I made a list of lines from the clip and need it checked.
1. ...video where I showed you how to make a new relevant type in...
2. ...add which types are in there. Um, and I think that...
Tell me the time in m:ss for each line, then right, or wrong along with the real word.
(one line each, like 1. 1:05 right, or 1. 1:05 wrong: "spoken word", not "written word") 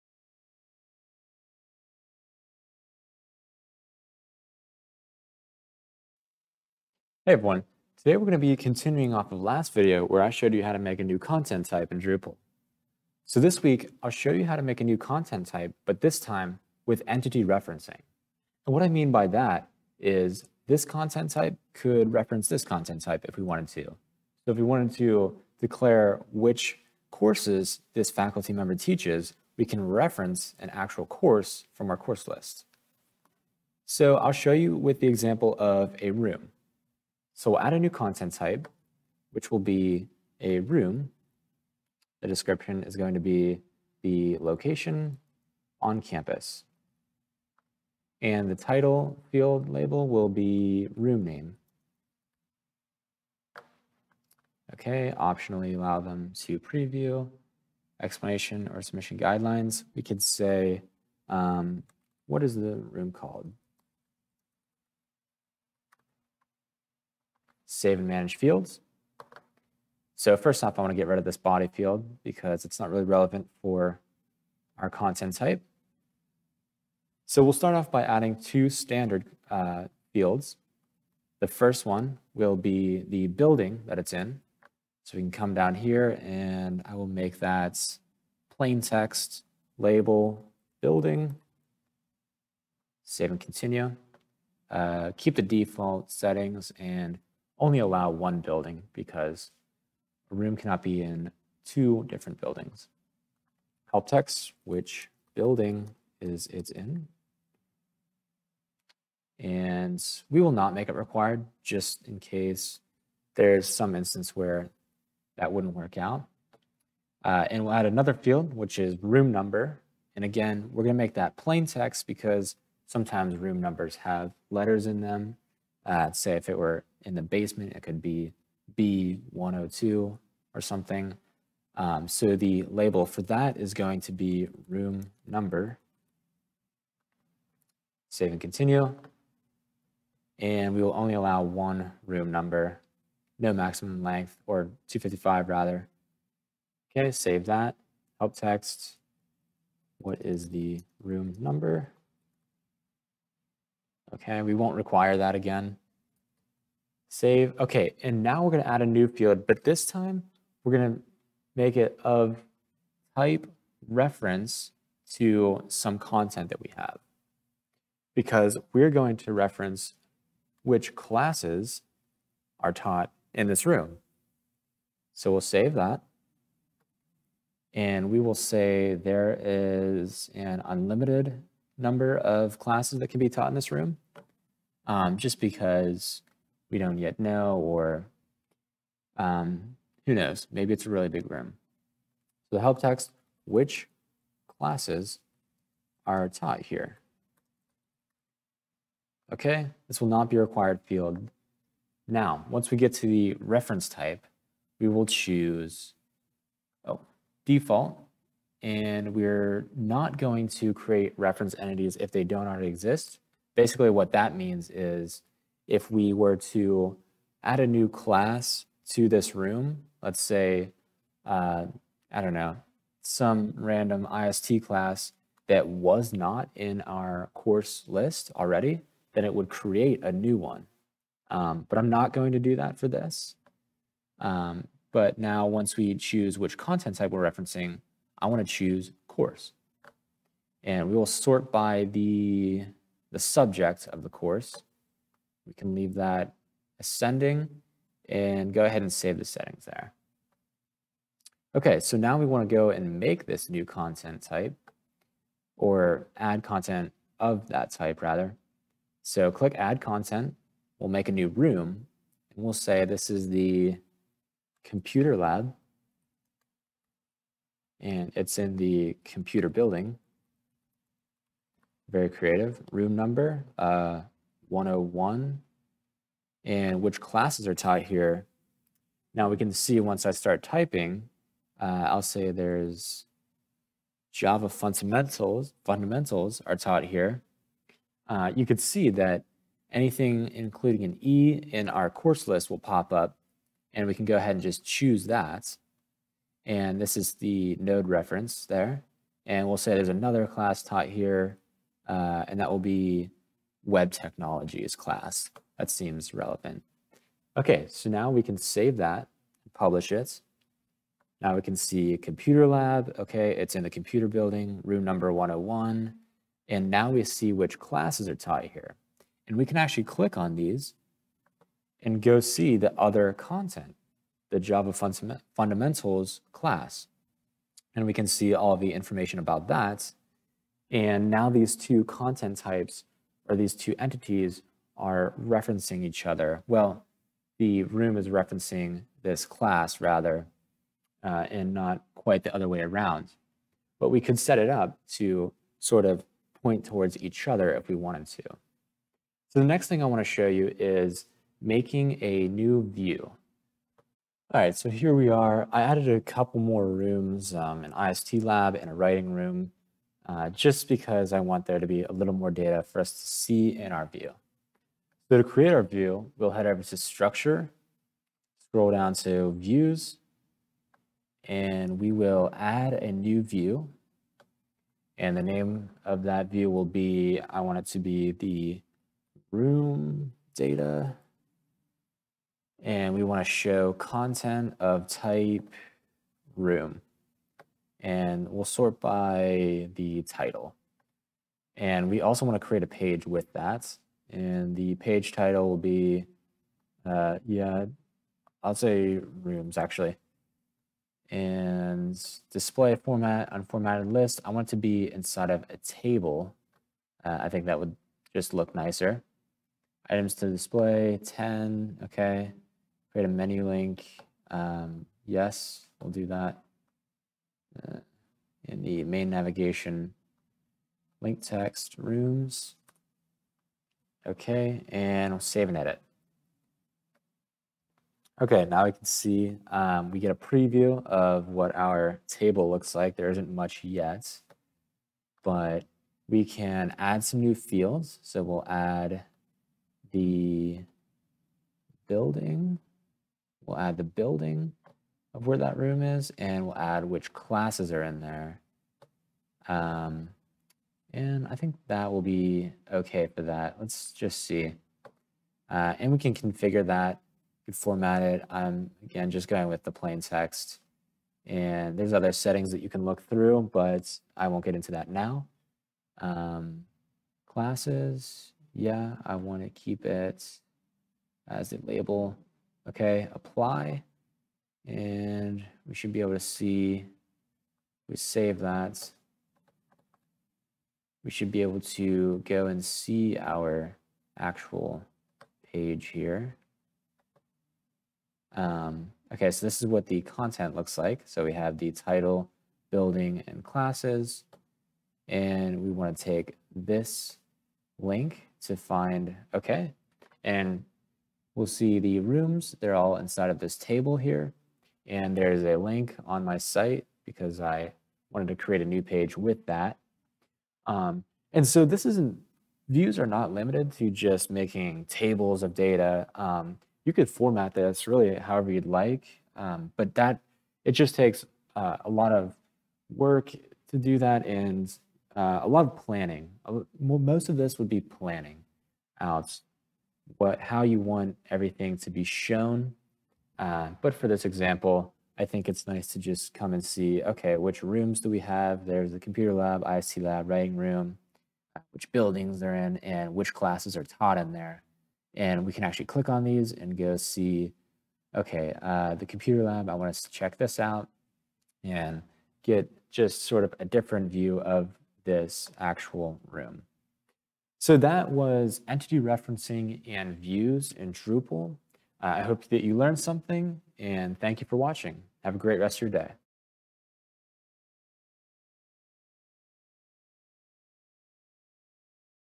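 1. 0:09 wrong: "content", not "relevant"
2. 7:26 wrong: "classes", not "types".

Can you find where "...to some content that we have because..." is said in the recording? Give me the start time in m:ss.
2:45.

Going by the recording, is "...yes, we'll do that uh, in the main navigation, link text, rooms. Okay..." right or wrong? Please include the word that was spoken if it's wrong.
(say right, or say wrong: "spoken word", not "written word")
right.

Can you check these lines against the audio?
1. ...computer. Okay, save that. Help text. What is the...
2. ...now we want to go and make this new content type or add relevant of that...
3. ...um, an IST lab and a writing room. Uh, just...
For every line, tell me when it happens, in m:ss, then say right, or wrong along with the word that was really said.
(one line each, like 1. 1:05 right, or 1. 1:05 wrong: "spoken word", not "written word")
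1. 2:25 wrong: "rather", not "computer"
2. 4:11 wrong: "content", not "relevant"
3. 5:57 right.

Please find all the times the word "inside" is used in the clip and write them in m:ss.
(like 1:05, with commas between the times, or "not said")
6:44, 8:22.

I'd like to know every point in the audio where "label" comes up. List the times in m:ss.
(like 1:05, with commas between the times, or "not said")
0:49, 1:29, 2:12, 7:51.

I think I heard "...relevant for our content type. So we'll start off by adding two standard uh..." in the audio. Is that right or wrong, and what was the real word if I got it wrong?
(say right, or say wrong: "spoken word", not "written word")
right.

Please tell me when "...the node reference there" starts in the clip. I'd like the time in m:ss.
4:57.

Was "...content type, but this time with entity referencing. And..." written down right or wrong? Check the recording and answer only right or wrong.
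right.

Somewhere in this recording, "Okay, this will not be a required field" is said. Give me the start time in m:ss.
3:19.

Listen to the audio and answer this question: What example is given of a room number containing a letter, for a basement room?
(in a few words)
B102.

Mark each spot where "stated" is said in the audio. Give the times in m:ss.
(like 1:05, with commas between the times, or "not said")
not said.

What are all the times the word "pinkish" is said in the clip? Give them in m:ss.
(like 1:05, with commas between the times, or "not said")
not said.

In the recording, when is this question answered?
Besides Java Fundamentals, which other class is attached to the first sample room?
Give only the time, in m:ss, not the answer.
5:03.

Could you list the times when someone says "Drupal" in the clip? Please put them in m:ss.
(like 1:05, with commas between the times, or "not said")
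0:12, 9:20.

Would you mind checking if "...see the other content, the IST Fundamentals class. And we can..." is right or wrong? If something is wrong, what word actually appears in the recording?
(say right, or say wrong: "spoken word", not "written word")
wrong: "Java", not "IST".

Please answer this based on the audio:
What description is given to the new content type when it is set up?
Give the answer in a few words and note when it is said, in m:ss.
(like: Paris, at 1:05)
Location on campus, at 0:44.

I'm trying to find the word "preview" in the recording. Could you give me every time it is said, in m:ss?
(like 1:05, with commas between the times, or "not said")
0:56, 7:10.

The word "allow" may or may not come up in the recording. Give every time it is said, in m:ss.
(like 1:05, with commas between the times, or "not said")
0:55, 1:37, 2:21.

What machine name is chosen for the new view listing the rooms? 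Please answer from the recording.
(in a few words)
Room data.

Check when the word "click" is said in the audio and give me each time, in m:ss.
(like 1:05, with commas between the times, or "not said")
4:19, 5:19, 9:05.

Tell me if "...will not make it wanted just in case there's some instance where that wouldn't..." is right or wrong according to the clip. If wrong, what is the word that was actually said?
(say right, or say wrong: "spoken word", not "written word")
wrong: "required", not "wanted".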